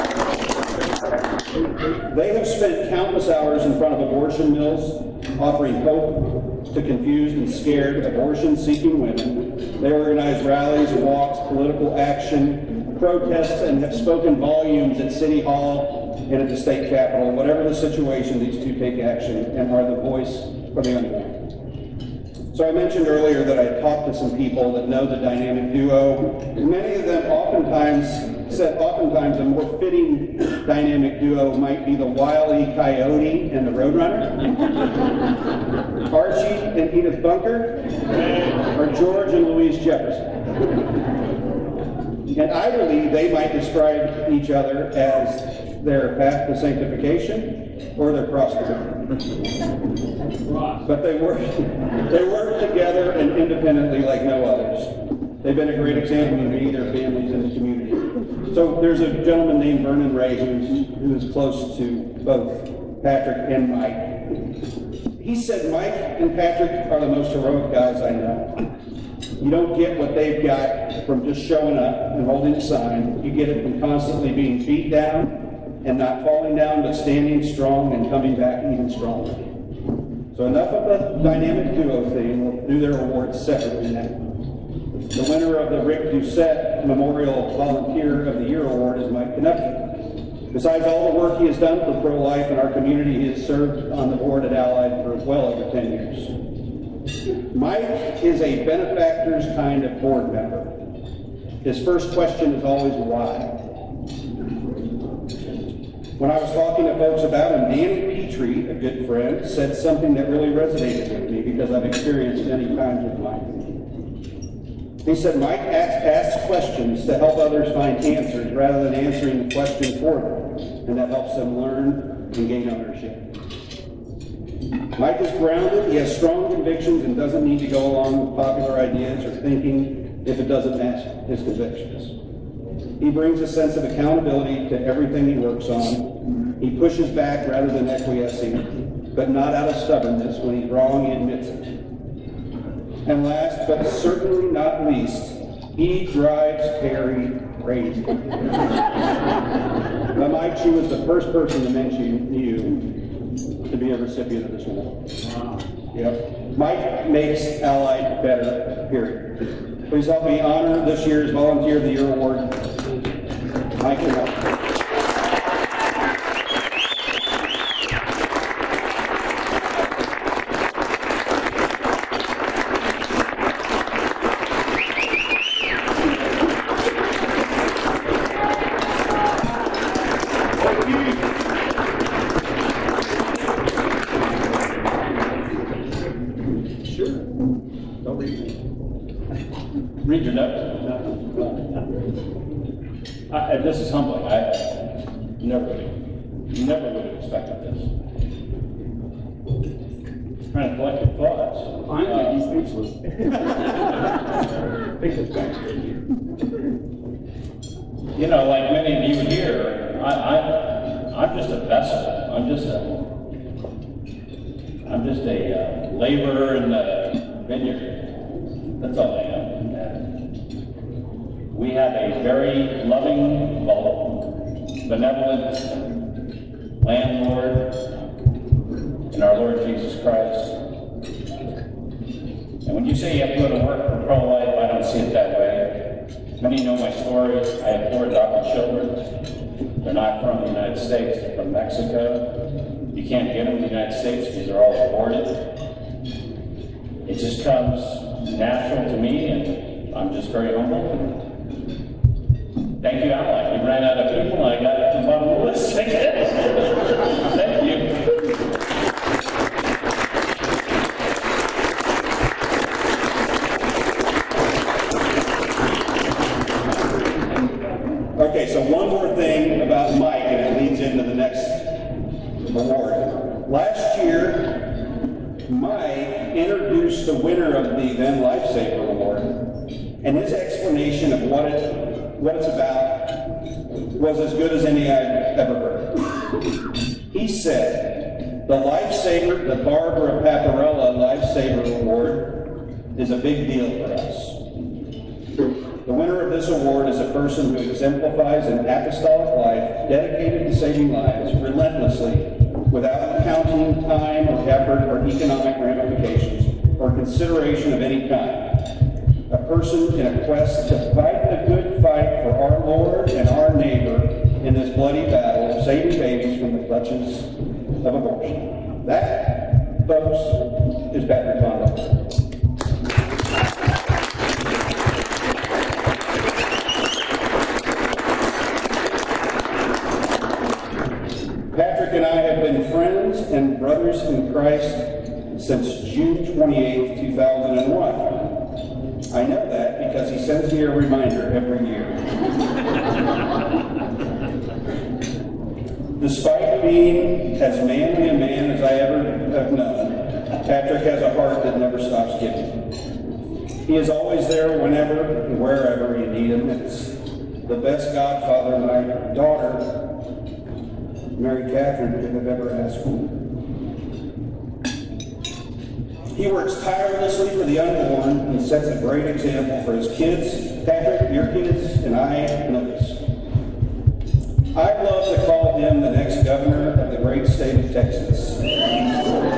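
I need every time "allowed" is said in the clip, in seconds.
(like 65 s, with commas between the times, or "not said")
not said.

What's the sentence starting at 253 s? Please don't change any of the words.
We ran out of people and I got to my list again.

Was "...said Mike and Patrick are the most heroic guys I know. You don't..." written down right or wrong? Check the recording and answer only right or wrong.
right.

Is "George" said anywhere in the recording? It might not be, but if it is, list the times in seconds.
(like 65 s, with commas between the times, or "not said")
38 s.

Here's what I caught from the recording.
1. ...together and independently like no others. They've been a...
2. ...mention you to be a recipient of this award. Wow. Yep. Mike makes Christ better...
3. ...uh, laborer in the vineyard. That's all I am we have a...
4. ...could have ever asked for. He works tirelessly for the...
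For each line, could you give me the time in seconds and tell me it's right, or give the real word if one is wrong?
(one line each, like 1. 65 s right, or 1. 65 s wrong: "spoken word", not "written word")
1. 52 s right
2. 151 s wrong: "Allied", not "Christ"
3. 215 s right
4. 362 s right.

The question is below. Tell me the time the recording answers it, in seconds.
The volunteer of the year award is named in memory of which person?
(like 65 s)
85 s.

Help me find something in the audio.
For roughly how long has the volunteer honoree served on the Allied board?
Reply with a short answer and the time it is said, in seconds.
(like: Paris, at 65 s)
over 10 years, at 95 s.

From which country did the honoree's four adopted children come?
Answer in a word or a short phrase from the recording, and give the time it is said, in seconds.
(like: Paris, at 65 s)
Mexico, at 241 s.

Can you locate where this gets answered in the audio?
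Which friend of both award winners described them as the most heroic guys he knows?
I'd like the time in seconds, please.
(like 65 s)
59 s.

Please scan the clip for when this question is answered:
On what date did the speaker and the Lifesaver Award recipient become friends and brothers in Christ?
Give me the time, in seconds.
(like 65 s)
335 s.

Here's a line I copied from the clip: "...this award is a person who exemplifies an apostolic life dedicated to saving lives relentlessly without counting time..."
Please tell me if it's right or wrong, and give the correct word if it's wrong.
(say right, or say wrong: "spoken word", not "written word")
right.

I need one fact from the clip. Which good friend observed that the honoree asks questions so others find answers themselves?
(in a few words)
Danny Petrie.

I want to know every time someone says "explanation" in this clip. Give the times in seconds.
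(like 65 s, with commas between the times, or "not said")
280 s.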